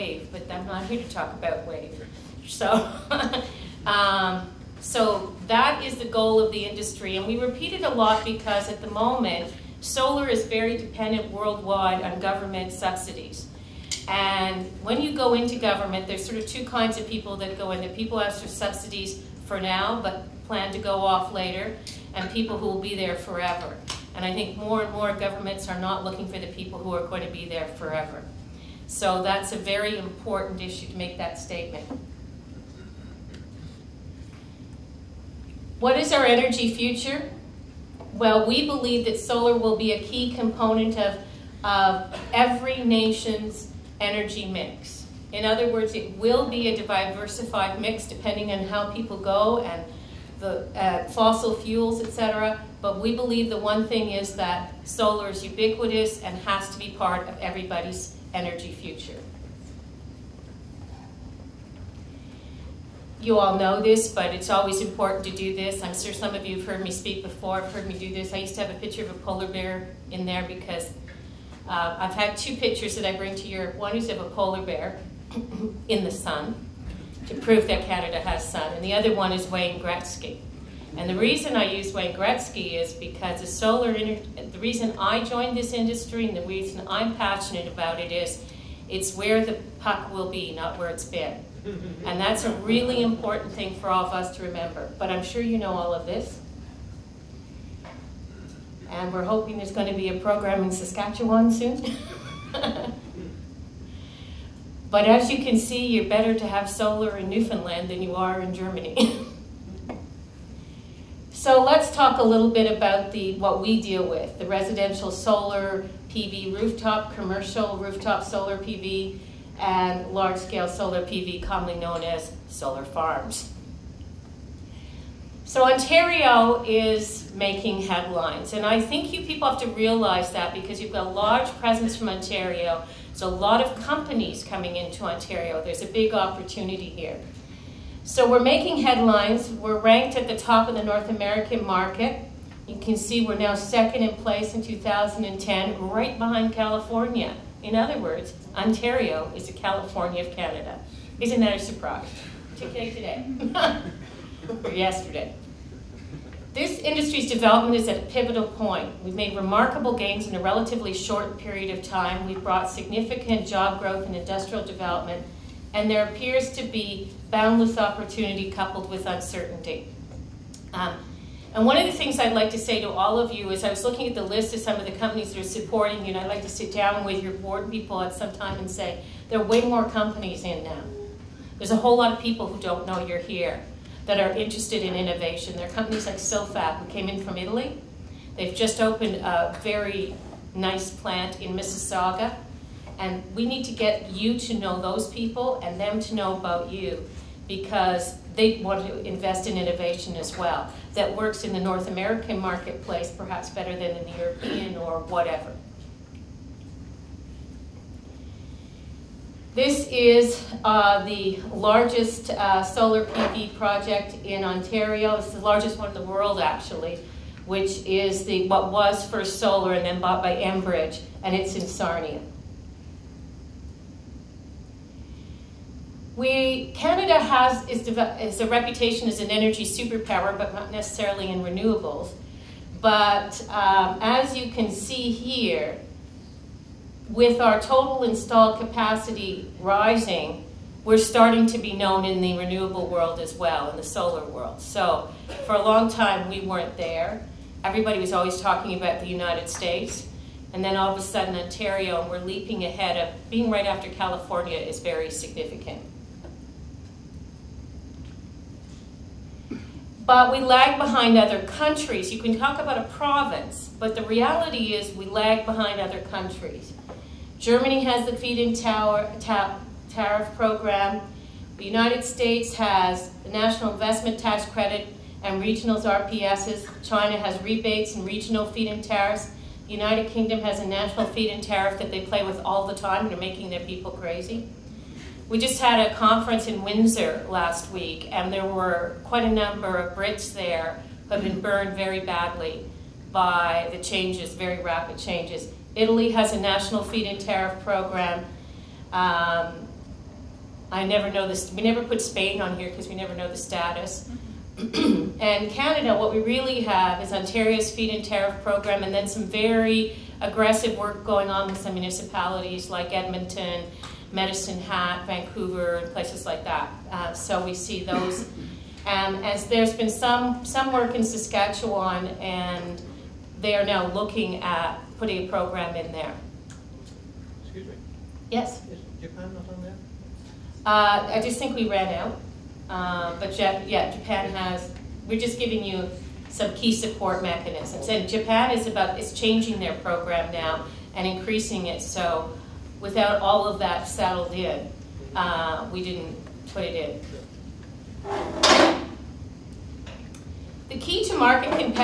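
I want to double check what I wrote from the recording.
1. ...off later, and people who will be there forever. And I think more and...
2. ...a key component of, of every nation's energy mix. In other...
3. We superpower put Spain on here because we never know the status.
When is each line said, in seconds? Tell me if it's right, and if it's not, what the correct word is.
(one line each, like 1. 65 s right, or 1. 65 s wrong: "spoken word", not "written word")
1. 21 s right
2. 39 s right
3. 301 s wrong: "never", not "superpower".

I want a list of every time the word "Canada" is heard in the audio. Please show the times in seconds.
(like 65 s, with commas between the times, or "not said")
77 s, 150 s, 226 s, 305 s.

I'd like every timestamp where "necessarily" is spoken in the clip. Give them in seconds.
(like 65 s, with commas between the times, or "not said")
230 s.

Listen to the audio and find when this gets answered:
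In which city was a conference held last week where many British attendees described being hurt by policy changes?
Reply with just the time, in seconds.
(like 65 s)
286 s.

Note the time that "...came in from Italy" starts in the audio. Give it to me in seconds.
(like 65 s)
186 s.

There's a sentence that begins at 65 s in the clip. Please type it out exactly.
I'm sure some of you have heard me speak before, have heard me do this.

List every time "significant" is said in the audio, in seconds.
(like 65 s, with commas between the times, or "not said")
162 s, 255 s.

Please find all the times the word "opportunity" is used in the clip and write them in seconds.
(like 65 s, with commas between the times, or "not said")
136 s, 167 s.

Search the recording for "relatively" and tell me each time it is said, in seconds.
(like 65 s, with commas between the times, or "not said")
160 s.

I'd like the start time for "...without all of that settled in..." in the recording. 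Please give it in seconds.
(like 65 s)
342 s.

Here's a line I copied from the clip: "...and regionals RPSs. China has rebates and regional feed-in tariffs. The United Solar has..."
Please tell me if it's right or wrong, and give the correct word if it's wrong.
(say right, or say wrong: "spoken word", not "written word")
wrong: "Kingdom", not "Solar".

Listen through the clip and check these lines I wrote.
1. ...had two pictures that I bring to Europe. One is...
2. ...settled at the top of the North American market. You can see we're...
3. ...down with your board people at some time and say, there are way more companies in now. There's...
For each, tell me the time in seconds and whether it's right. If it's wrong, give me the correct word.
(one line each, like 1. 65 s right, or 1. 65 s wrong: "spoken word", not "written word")
1. 72 s right
2. 139 s wrong: "ranked", not "settled"
3. 176 s right.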